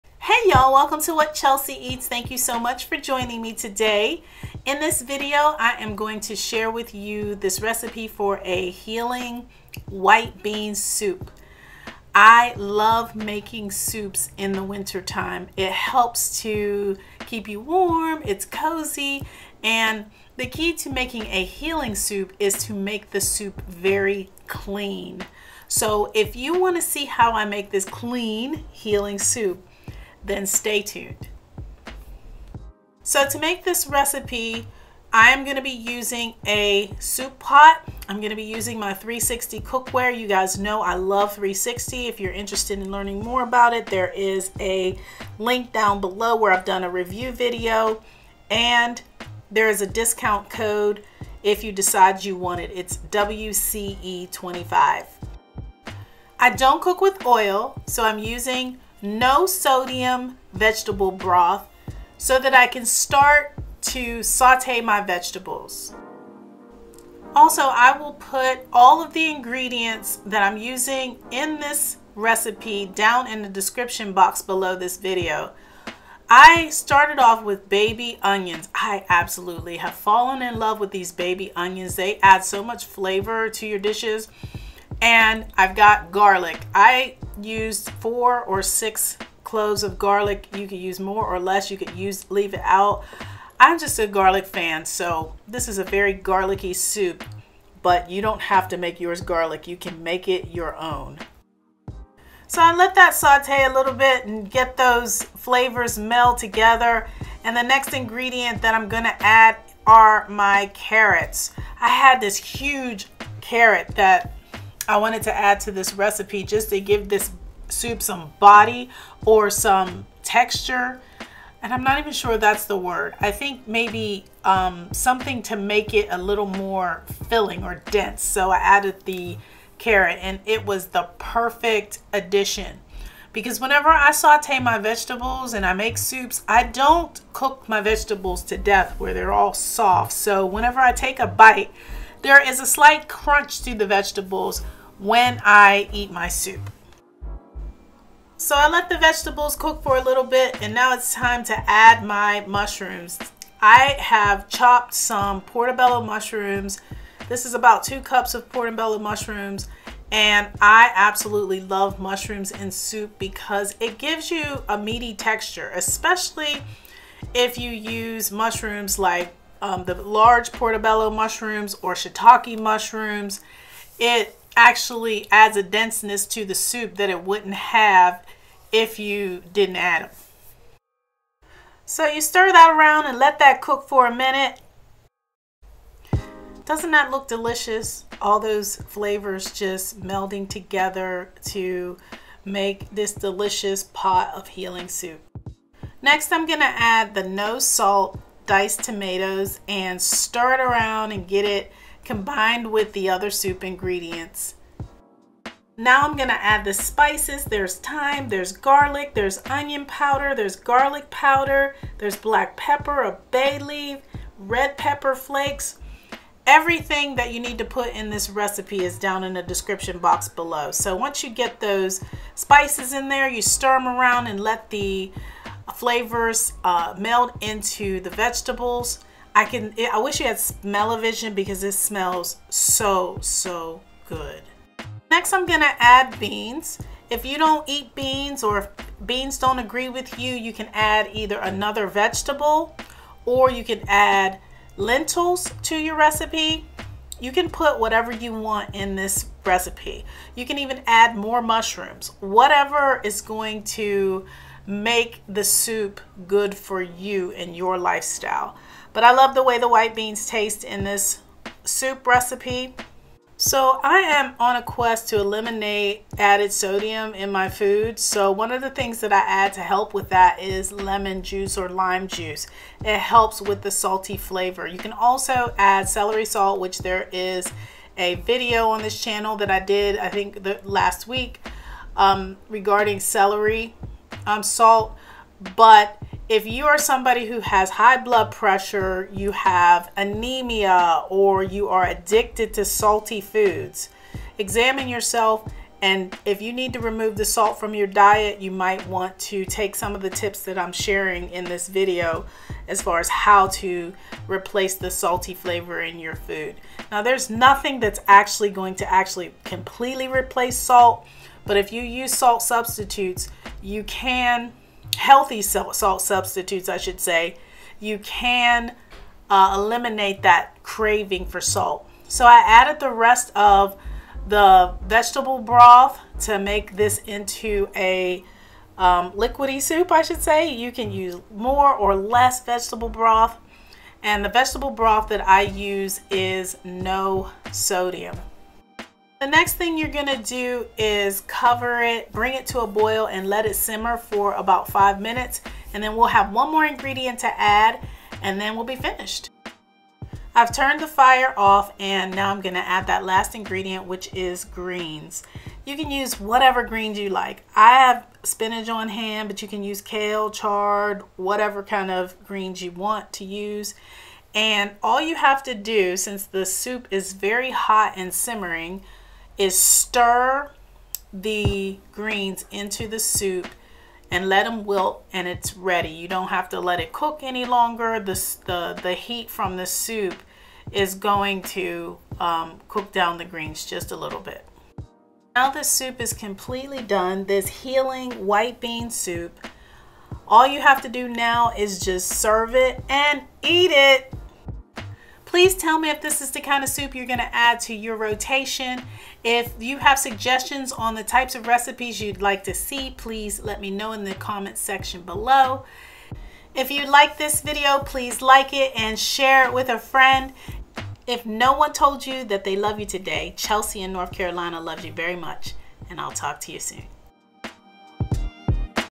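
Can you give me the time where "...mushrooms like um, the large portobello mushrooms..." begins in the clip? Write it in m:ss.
2:48.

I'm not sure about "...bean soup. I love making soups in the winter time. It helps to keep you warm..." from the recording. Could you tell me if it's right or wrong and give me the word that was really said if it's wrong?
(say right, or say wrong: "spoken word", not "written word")
right.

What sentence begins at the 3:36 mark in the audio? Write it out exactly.
Everything that you need to put in this recipe is down in the description box below.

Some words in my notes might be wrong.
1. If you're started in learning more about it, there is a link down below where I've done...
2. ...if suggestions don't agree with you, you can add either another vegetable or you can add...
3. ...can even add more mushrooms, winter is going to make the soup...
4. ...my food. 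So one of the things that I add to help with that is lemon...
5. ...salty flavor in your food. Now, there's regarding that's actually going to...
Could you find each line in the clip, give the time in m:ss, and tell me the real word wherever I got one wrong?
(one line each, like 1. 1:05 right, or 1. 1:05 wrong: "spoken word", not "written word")
1. 0:42 wrong: "interested", not "started"
2. 3:58 wrong: "beans", not "suggestions"
3. 4:10 wrong: "whatever", not "winter"
4. 4:27 right
5. 5:04 wrong: "nothing", not "regarding".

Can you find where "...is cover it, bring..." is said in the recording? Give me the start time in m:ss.
5:40.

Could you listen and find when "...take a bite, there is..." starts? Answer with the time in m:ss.
2:20.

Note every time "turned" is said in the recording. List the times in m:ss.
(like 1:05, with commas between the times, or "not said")
5:50.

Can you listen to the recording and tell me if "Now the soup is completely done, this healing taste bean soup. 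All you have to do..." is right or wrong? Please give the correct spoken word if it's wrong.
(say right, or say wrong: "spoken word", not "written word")
wrong: "white", not "taste".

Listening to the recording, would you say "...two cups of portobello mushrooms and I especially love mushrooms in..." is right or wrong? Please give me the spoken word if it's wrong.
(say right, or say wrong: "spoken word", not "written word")
wrong: "absolutely", not "especially".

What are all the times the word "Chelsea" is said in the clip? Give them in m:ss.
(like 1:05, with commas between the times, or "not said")
0:01, 6:53.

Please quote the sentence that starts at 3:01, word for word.
So you stir that around and let that cook for a minute.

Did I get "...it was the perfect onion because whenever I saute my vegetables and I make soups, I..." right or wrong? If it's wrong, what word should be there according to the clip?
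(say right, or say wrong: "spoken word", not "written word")
wrong: "addition", not "onion".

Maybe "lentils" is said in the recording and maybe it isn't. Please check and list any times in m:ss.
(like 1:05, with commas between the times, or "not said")
4:04.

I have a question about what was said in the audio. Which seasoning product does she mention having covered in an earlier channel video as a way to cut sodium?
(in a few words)
Celery salt.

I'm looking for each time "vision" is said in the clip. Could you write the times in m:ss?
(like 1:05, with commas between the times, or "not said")
3:50.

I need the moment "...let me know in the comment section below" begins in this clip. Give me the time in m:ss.
6:43.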